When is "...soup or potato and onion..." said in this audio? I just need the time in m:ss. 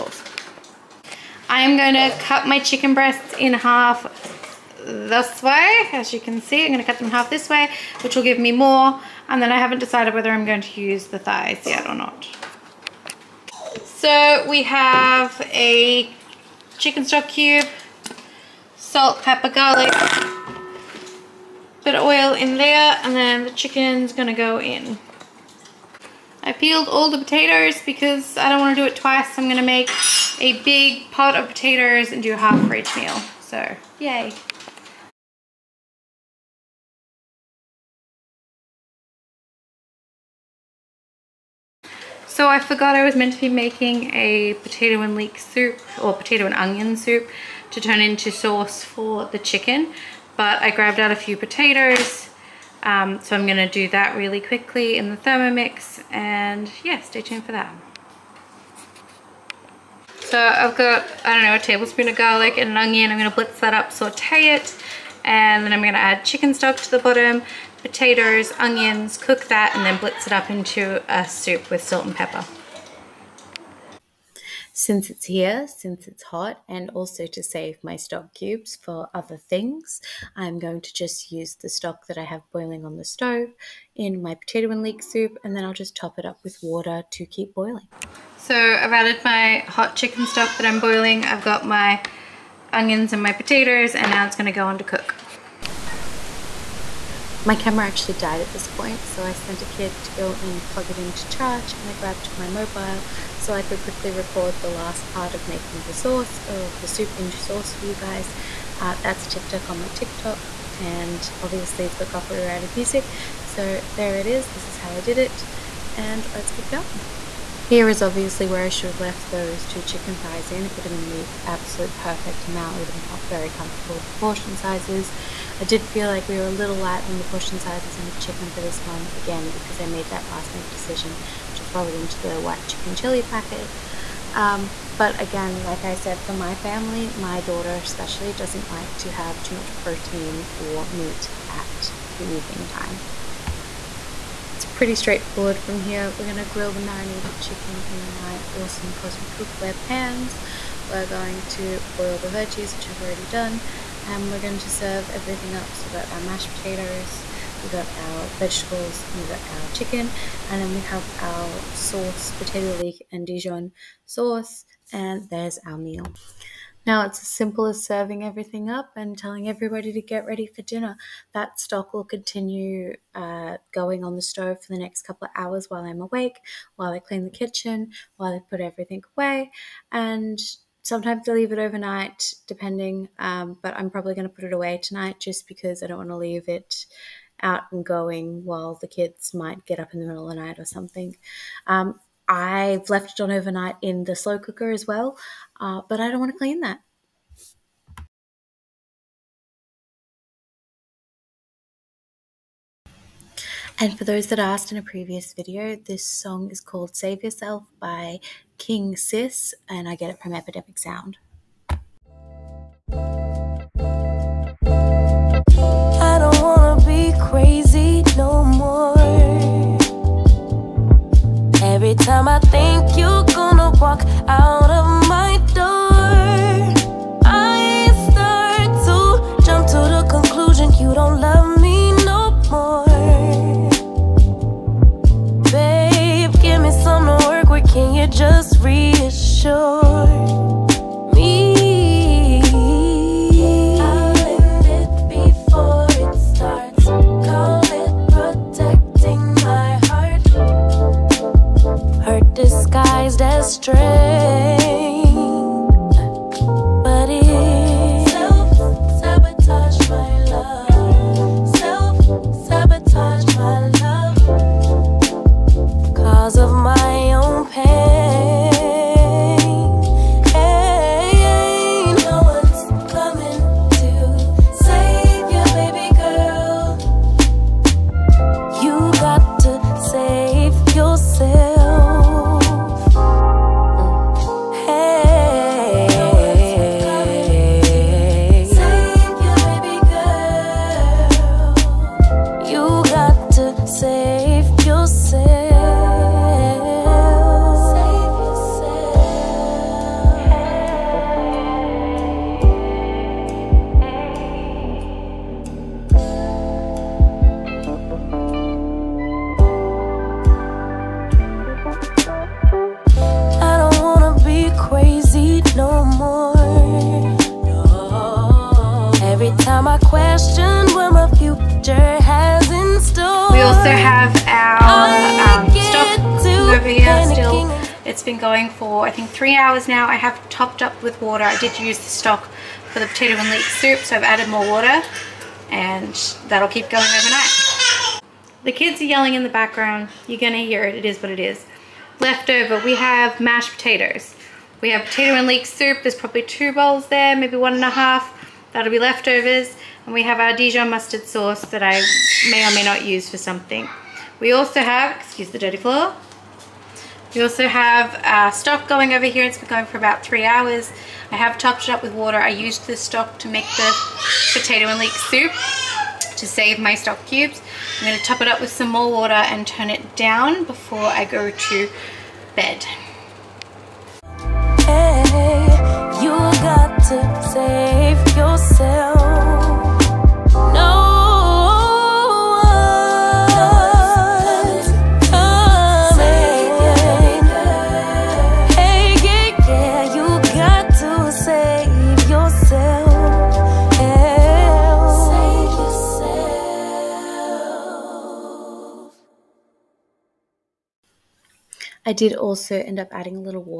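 0:45.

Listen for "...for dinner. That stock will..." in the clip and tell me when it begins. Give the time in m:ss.
2:50.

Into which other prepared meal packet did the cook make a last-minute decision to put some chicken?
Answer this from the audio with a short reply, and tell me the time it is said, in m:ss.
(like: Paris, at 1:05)
White chicken chili, at 2:12.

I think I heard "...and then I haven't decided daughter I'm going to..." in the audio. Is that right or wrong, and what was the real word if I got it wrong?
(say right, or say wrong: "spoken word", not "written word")
wrong: "whether", not "daughter".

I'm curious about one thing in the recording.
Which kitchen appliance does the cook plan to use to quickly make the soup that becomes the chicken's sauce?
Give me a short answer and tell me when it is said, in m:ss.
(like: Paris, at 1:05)
Thermomix, at 0:55.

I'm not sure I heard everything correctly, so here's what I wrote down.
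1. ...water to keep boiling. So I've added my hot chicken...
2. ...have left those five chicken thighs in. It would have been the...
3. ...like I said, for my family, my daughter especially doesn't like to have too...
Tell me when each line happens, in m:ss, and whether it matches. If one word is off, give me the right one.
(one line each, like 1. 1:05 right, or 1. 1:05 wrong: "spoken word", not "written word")
1. 1:26 right
2. 1:58 wrong: "two", not "five"
3. 2:15 right.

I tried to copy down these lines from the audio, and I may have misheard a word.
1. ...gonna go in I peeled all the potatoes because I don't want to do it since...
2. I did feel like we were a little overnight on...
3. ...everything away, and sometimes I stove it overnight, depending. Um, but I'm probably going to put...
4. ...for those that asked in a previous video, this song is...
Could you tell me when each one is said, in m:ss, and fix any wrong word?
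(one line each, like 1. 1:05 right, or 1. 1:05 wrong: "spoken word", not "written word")
1. 0:24 wrong: "twice", not "since"
2. 2:05 wrong: "light", not "overnight"
3. 2:58 wrong: "leave", not "stove"
4. 3:23 right.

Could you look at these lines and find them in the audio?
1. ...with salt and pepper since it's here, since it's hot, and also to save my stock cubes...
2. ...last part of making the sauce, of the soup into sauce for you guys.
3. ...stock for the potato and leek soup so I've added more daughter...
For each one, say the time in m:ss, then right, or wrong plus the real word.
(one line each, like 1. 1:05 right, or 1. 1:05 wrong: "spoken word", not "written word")
1. 1:11 right
2. 1:44 right
3. 5:31 wrong: "water", not "daughter".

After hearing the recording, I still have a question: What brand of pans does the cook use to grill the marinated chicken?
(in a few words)
Cosmic Cookware.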